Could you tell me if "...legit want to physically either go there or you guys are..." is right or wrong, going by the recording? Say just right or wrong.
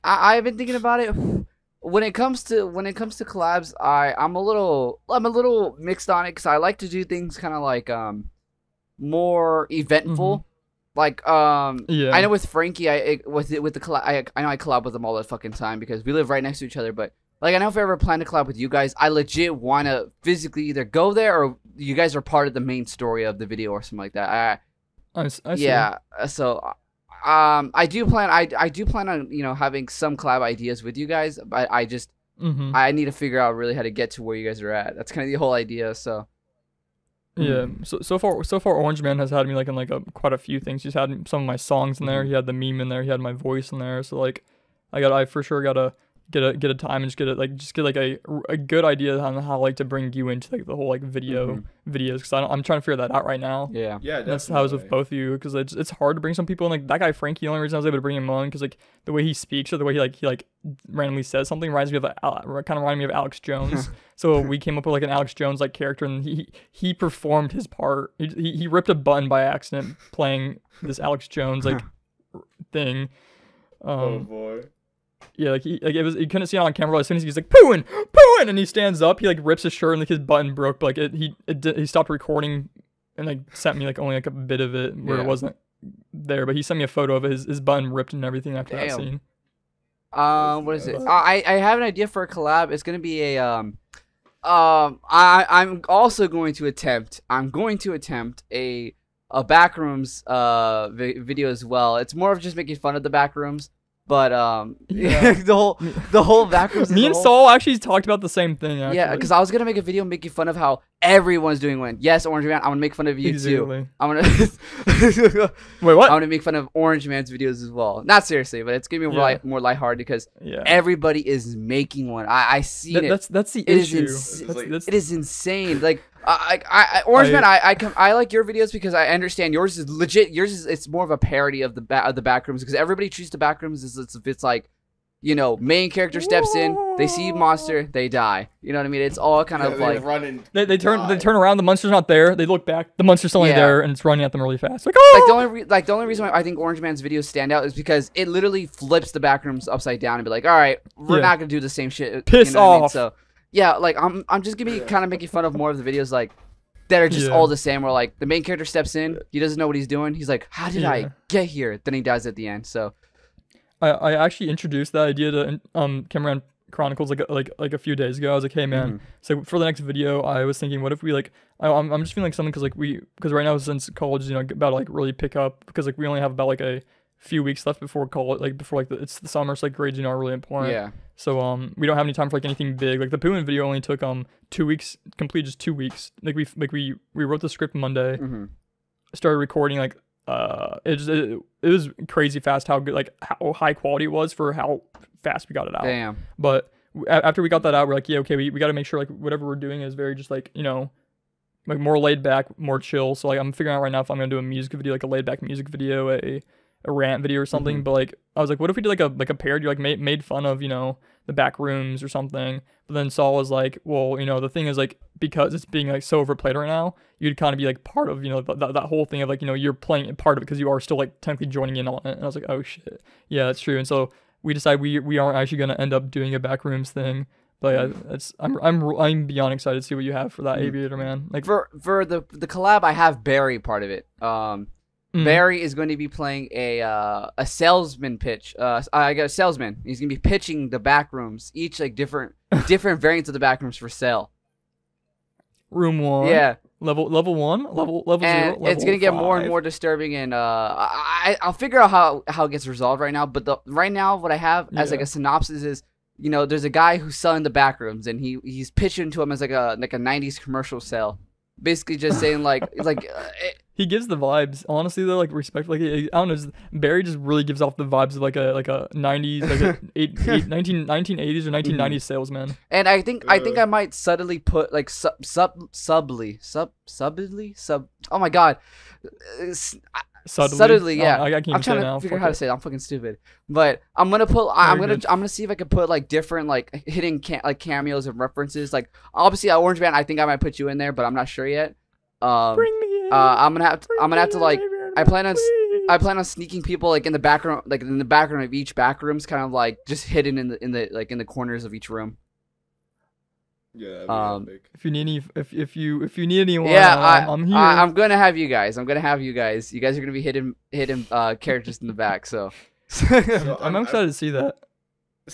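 right.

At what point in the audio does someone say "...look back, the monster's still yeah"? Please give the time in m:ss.
2:22.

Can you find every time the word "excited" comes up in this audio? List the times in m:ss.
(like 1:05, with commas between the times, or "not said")
3:49, 5:13.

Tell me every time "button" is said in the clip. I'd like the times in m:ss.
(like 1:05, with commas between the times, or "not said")
1:20, 1:27.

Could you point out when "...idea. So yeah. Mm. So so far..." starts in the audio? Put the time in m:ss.
0:35.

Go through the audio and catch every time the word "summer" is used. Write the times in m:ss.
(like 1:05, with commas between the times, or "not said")
2:59.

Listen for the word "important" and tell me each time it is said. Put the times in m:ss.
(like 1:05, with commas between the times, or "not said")
3:00.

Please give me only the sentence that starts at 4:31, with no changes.
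salesman and i think i think uh.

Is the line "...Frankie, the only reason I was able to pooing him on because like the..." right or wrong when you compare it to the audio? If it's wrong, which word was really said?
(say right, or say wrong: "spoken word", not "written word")
wrong: "bring", not "pooing".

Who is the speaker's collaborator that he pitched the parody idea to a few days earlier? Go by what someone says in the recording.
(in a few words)
Cameron Chronicles.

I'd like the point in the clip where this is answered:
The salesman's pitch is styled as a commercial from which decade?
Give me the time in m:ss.
4:19.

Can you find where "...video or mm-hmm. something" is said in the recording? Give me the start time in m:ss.
3:27.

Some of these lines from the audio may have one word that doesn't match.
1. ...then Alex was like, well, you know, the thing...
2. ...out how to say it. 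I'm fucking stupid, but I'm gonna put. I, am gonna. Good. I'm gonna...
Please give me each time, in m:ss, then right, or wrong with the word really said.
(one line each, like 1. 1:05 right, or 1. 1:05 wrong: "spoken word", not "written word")
1. 3:32 wrong: "Saul", not "Alex"
2. 4:42 right.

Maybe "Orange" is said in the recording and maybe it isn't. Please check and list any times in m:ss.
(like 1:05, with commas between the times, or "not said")
0:38, 1:52, 1:56, 2:07, 2:26, 4:49.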